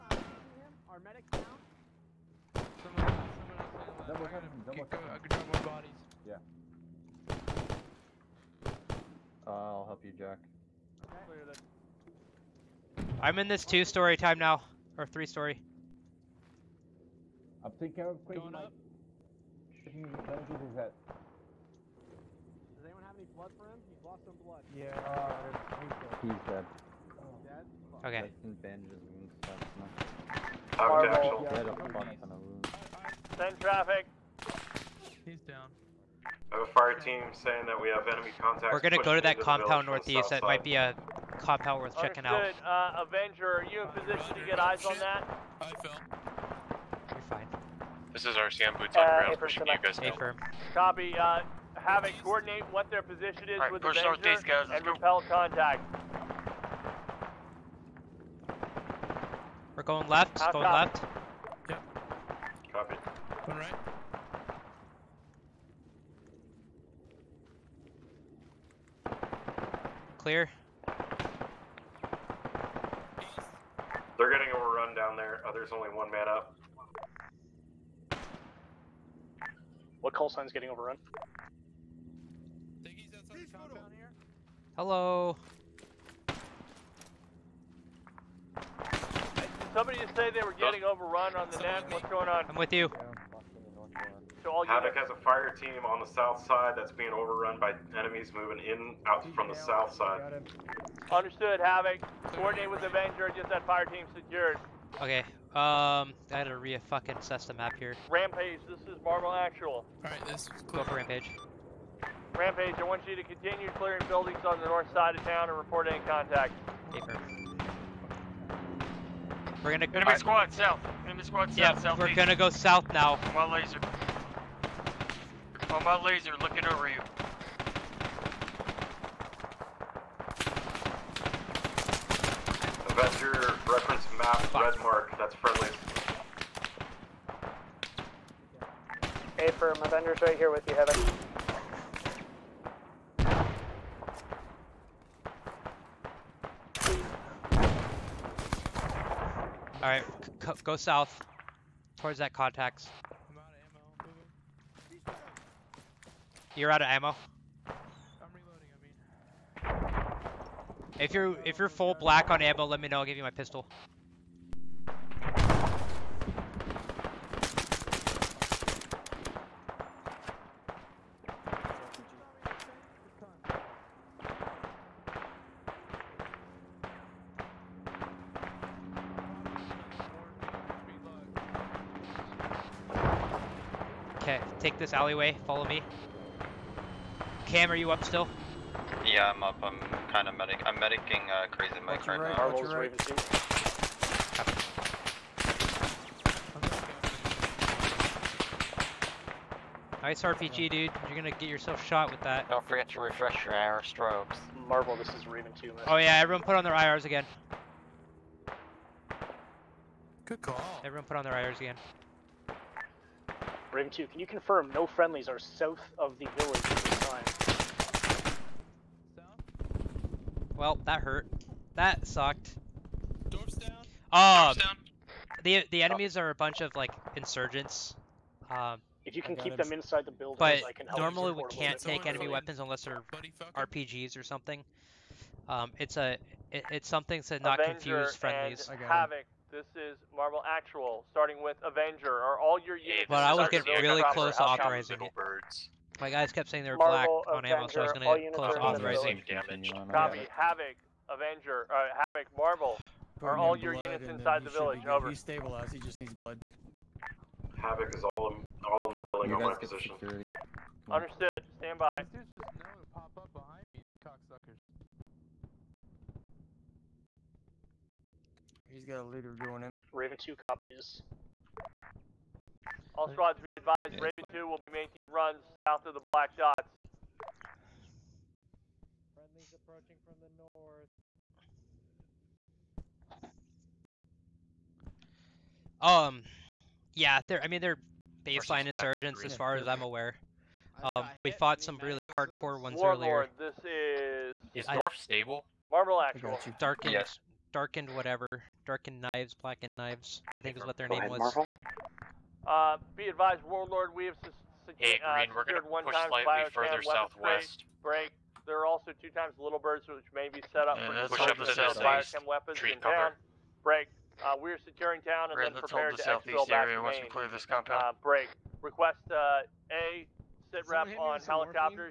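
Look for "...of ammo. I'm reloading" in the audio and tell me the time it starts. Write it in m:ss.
2:36.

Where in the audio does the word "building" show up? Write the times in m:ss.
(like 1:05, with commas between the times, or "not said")
1:54, 3:50, 4:19.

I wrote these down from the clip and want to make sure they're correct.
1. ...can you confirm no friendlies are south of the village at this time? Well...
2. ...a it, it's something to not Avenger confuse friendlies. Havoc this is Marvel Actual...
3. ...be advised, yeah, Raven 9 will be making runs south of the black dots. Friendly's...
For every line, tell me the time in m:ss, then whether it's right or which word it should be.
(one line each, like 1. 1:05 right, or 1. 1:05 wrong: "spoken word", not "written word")
1. 3:34 right
2. 3:55 right
3. 4:33 wrong: "2", not "9".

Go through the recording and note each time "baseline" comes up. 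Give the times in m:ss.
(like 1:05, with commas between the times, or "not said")
4:48.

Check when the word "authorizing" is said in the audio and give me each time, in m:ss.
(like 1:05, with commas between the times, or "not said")
4:04, 4:08.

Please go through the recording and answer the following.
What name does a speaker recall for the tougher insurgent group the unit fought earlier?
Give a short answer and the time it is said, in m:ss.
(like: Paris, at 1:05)
Blackened knives, at 4:59.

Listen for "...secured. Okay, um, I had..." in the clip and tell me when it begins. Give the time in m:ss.
1:44.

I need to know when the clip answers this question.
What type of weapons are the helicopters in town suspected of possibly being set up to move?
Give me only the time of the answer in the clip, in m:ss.
5:11.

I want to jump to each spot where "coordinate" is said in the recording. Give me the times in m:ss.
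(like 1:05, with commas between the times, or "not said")
0:52, 1:42.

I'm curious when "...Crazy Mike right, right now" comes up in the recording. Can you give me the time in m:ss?
3:11.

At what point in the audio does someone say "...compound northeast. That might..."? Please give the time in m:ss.
0:39.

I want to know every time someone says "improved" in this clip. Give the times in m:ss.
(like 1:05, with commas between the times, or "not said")
not said.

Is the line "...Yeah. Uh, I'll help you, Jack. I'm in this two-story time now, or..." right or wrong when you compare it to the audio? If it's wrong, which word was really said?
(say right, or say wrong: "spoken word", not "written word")
right.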